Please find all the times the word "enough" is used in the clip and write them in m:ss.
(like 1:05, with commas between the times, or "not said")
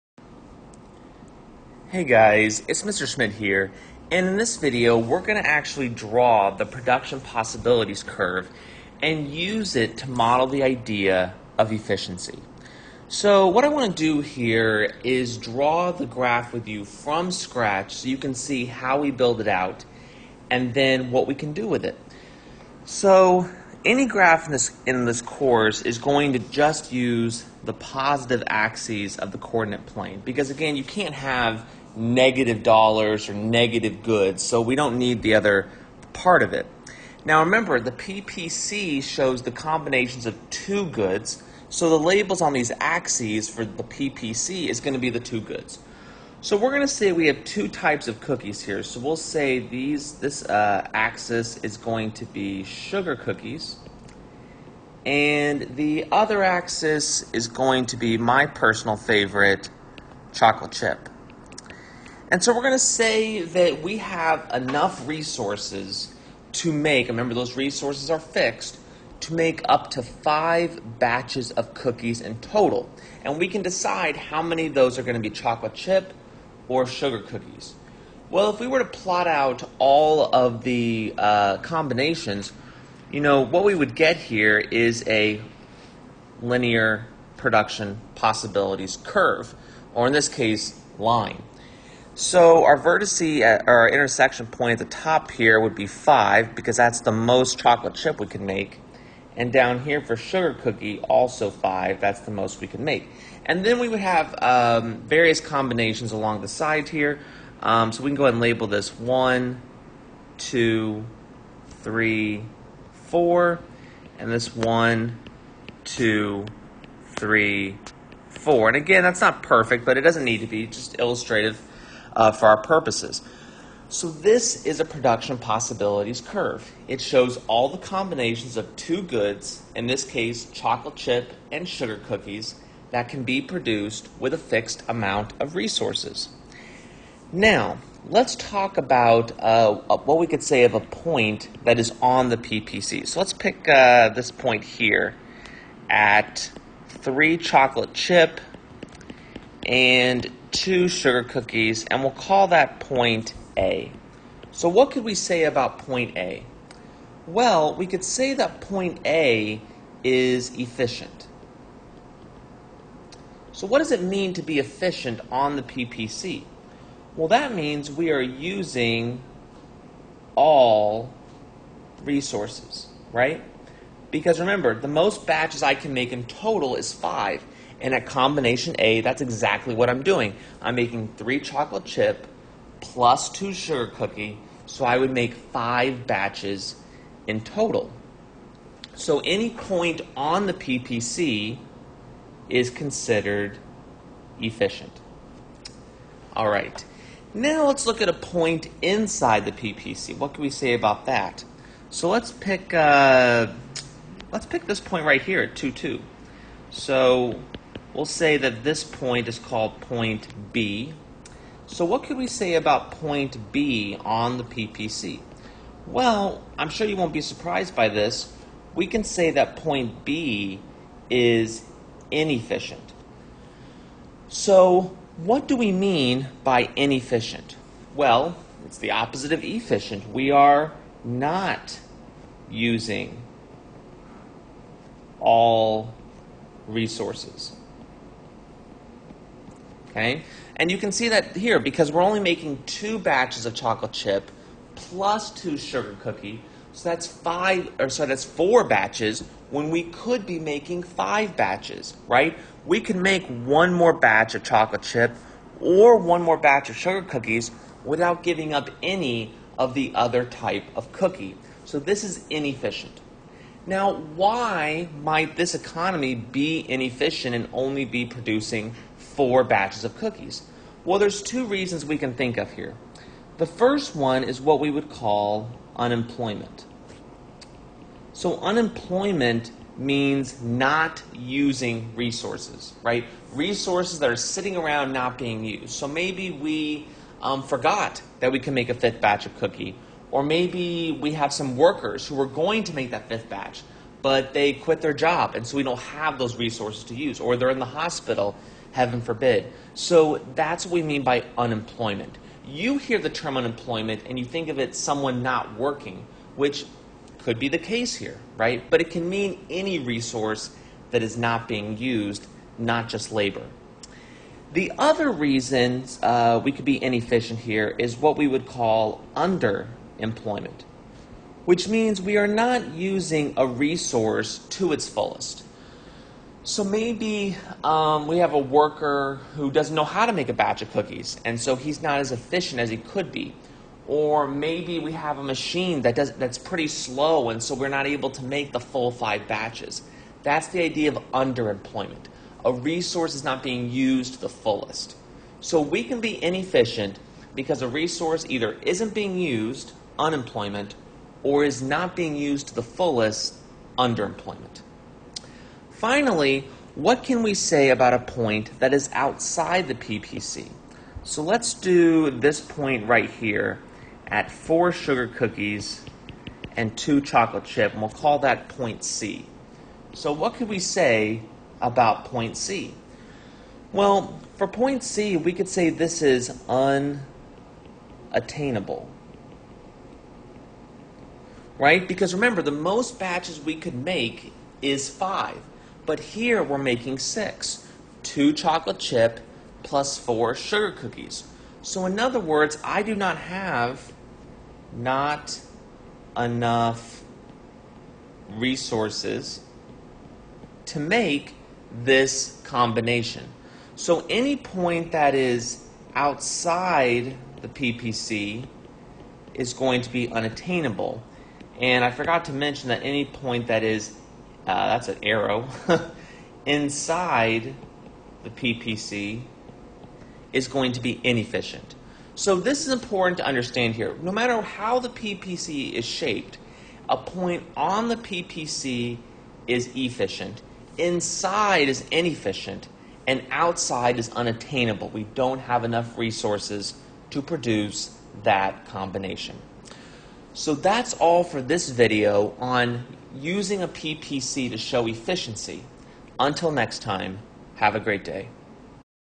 1:04, 6:36, 7:15.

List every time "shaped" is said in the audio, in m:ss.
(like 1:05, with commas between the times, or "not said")
7:05.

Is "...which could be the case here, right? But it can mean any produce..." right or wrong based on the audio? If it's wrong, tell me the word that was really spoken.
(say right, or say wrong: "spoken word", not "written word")
wrong: "resource", not "produce".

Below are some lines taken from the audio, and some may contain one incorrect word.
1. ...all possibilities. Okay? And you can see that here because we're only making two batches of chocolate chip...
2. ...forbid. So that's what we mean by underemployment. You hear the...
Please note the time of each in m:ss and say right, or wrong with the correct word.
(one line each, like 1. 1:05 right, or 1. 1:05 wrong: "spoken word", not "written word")
1. 3:55 wrong: "resources", not "possibilities"
2. 4:59 wrong: "unemployment", not "underemployment".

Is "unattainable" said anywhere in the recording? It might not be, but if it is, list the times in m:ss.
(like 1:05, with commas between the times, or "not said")
6:16, 6:50, 7:14.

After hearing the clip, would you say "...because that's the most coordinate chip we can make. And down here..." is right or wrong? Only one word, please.
wrong.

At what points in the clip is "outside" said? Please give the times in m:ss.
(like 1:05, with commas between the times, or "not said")
5:58, 6:45, 7:13.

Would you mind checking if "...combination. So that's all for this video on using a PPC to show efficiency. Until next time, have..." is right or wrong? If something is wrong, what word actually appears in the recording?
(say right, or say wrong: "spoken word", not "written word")
right.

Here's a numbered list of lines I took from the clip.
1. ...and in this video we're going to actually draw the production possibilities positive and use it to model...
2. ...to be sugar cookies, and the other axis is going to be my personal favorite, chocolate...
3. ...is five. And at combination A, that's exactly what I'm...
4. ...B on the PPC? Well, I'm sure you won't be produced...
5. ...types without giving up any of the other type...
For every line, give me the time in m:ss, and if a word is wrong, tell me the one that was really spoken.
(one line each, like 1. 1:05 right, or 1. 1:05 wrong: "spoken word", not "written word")
1. 0:04 wrong: "curve", not "positive"
2. 0:52 right
3. 2:56 right
4. 3:33 wrong: "surprised", not "produced"
5. 4:17 wrong: "cookies", not "types".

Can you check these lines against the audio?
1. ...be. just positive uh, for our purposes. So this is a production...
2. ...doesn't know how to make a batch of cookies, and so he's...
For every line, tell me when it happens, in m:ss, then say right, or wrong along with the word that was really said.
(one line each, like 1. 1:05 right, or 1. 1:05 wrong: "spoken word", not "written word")
1. 2:00 wrong: "illustrative", not "positive"
2. 5:29 right.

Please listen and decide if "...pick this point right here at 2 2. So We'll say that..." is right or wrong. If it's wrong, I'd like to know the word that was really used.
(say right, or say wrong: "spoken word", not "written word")
right.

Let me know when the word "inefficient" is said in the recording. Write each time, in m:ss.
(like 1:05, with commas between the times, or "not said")
3:42, 3:46, 4:22, 4:26, 5:16, 5:46, 7:01, 7:11.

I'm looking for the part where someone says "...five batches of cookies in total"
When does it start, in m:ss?
1:10.